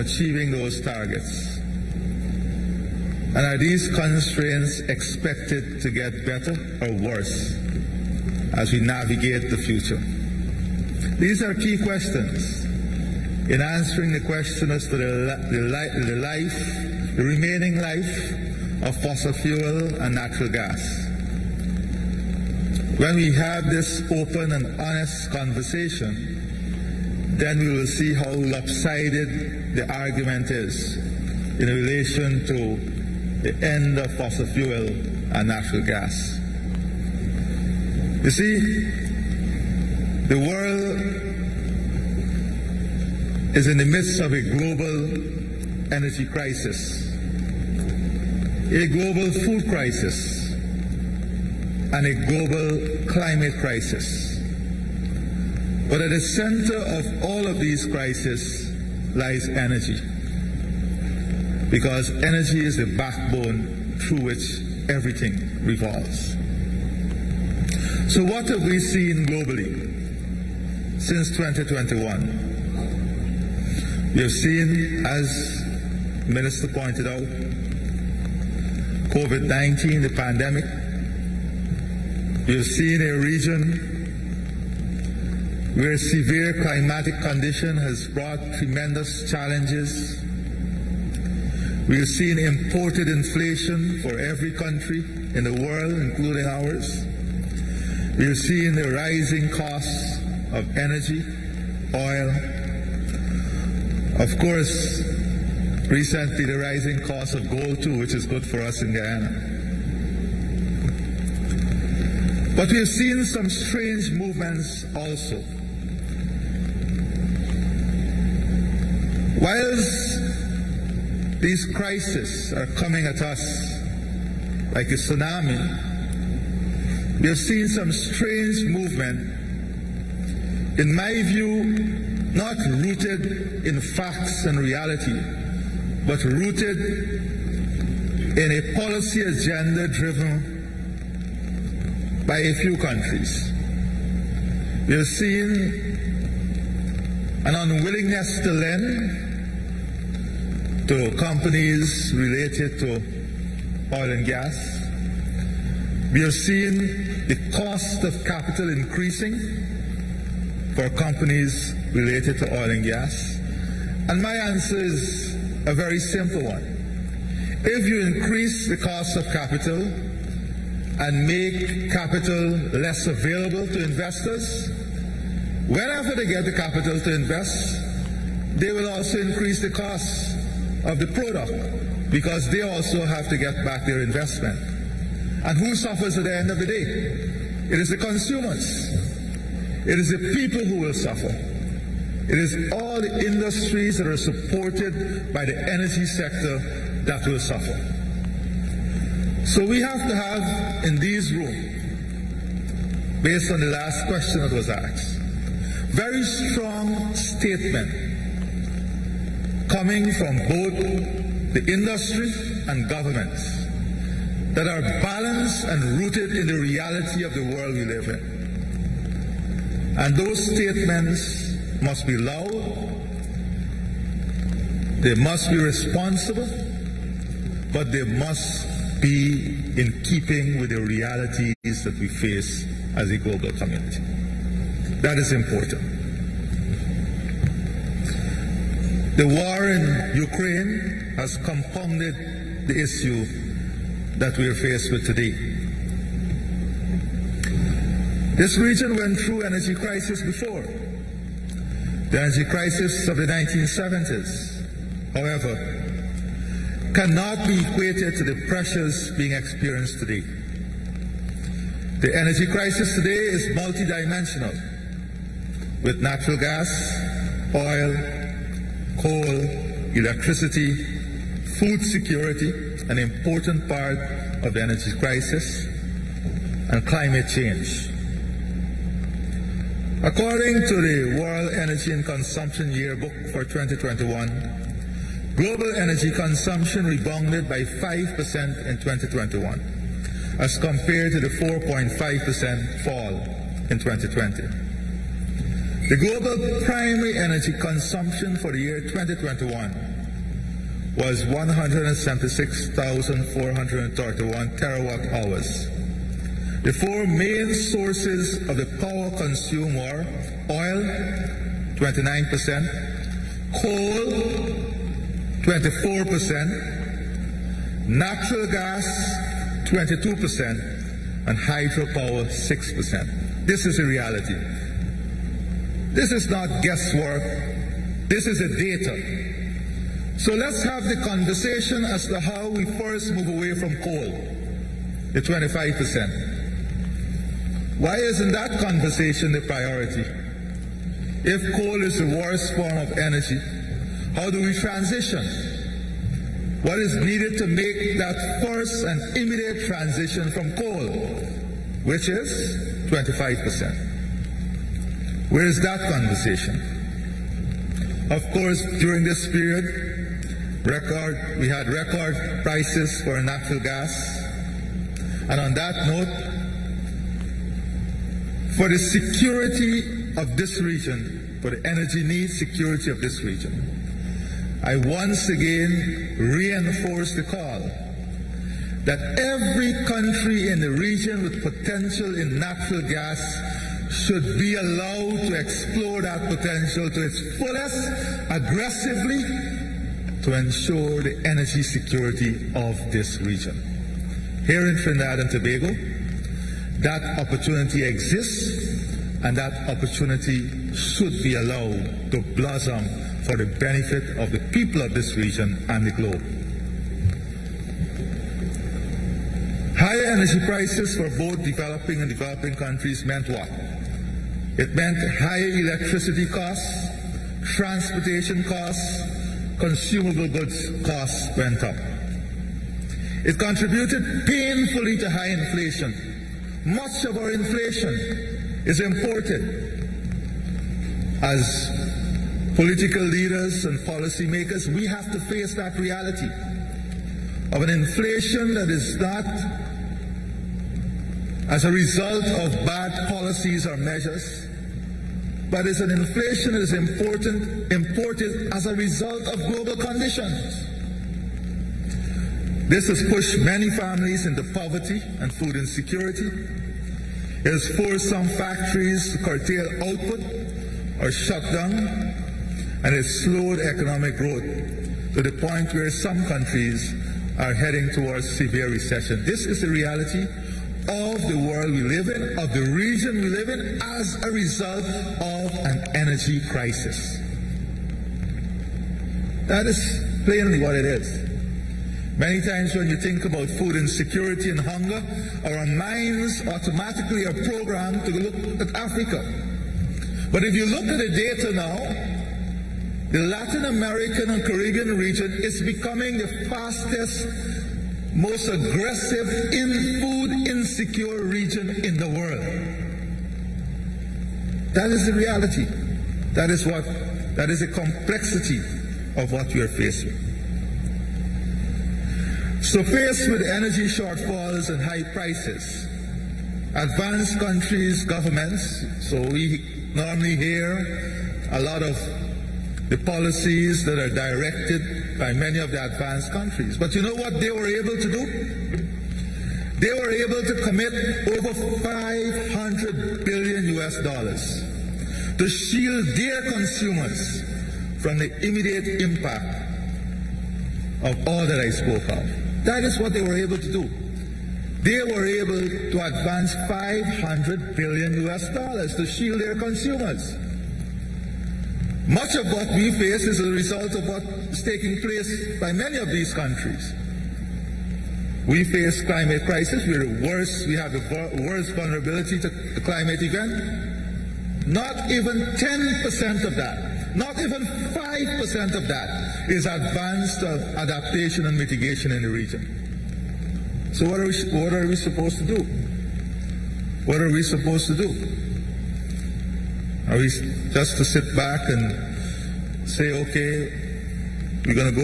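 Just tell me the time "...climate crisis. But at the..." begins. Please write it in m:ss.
0:53.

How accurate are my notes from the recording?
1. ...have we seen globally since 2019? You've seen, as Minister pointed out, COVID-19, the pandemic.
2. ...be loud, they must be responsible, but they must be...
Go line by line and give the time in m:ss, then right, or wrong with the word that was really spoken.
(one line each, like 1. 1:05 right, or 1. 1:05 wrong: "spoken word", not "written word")
1. 1:08 wrong: "2021", not "2019"
2. 3:42 right.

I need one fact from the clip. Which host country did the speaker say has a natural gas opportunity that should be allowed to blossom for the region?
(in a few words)
Trinidad and Tobago.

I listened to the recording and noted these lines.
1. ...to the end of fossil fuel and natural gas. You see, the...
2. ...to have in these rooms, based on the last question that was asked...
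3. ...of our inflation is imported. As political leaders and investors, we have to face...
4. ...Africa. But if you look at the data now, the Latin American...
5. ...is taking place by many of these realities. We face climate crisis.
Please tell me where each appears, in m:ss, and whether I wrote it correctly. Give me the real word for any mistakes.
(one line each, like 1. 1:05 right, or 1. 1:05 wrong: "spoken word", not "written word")
1. 0:32 right
2. 3:20 right
3. 7:07 wrong: "policymakers", not "investors"
4. 8:08 right
5. 9:14 wrong: "countries", not "realities".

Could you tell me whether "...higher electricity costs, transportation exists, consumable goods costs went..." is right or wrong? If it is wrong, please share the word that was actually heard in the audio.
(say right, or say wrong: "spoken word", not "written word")
wrong: "costs", not "exists".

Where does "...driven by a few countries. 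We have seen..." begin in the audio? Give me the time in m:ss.
2:19.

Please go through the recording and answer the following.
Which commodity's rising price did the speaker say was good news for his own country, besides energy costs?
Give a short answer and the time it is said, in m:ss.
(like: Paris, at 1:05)
gold, at 1:47.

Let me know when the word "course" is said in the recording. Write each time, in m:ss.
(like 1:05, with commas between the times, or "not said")
1:44, 5:58.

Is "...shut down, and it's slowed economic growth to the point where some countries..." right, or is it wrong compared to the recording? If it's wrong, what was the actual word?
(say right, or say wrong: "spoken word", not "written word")
right.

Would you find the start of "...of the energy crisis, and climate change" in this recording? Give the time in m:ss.
4:34.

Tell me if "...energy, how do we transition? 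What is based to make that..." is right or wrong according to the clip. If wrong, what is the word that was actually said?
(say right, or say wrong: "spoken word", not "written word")
wrong: "needed", not "based".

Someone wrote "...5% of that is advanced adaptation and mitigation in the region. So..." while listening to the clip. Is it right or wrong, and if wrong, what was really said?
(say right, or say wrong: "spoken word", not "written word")
right.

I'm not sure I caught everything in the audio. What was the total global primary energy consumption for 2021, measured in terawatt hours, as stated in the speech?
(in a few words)
176,431.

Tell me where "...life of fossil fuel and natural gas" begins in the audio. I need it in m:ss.
0:17.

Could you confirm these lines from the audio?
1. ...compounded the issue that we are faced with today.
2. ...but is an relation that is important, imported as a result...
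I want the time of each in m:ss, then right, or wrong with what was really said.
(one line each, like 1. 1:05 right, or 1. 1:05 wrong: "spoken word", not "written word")
1. 4:01 right
2. 7:25 wrong: "inflation", not "relation".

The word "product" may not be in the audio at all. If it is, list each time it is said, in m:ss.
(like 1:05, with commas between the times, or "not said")
3:01.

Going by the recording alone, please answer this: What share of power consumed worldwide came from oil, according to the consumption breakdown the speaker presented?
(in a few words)
29%.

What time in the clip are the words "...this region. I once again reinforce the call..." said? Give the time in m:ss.
6:12.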